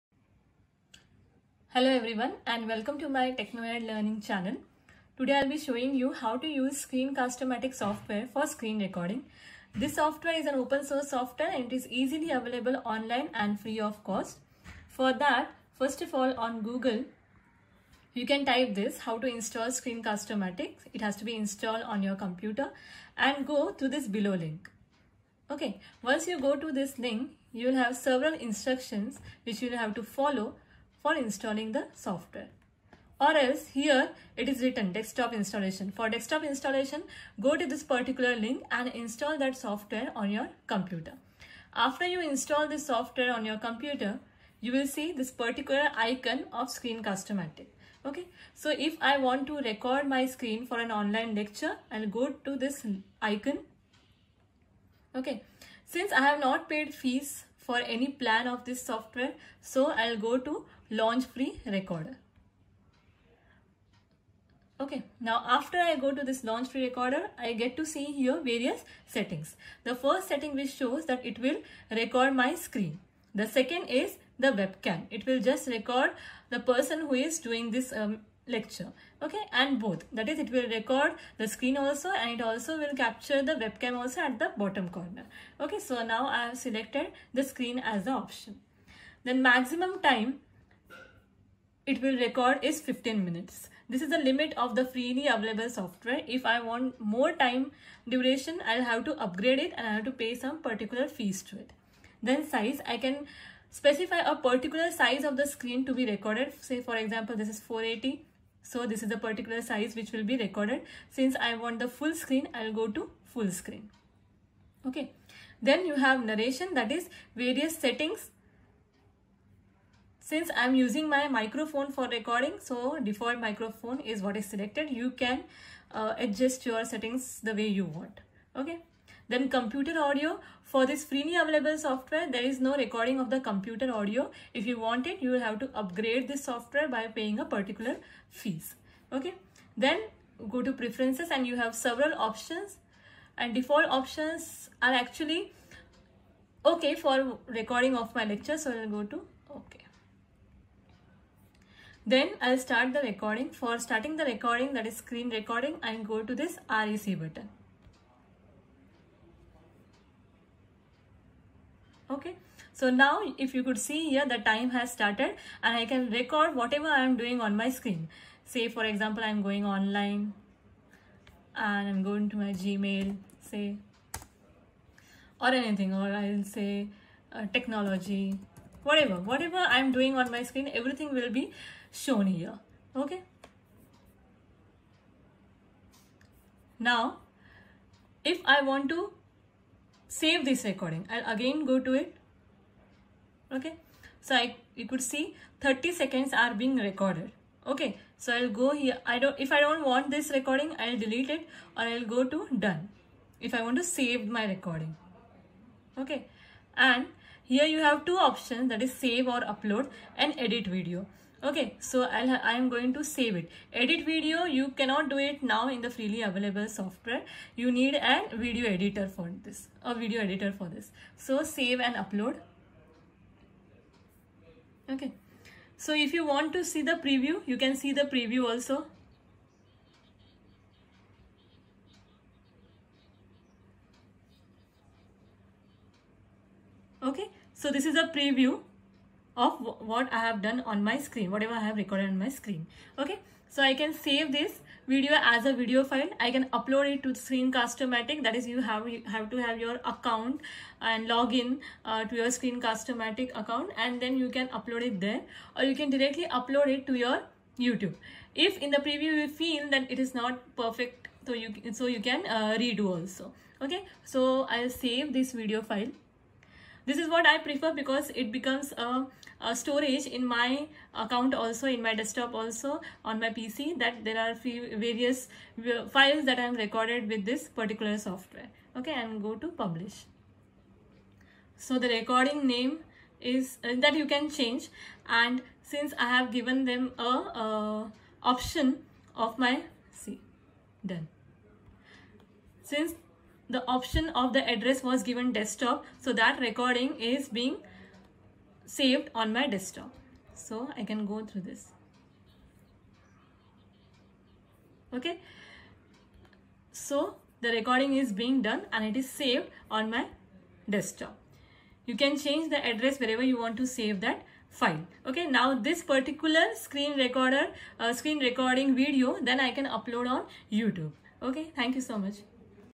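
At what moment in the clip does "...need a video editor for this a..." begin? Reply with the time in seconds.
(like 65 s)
217 s.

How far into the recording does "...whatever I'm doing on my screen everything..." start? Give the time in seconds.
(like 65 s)
179 s.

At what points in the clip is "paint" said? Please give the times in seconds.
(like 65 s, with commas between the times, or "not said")
not said.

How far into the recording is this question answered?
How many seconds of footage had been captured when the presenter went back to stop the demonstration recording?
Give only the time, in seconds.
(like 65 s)
195 s.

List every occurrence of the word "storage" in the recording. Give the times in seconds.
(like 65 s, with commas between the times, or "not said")
269 s.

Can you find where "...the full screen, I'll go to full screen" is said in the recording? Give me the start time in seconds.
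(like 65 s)
111 s.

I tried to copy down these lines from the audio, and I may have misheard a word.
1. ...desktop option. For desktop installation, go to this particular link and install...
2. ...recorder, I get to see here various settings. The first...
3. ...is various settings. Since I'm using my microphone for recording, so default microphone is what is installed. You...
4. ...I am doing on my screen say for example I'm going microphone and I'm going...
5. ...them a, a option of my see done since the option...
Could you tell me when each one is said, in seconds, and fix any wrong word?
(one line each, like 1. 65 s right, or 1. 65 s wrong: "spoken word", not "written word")
1. 34 s wrong: "installation", not "option"
2. 66 s right
3. 116 s wrong: "selected", not "installed"
4. 166 s wrong: "online", not "microphone"
5. 286 s right.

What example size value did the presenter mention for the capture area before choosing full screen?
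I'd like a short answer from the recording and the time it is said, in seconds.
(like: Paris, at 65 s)
480, at 107 s.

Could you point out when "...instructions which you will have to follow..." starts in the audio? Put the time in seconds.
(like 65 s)
28 s.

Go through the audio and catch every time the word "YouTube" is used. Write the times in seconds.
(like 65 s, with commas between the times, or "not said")
257 s, 320 s.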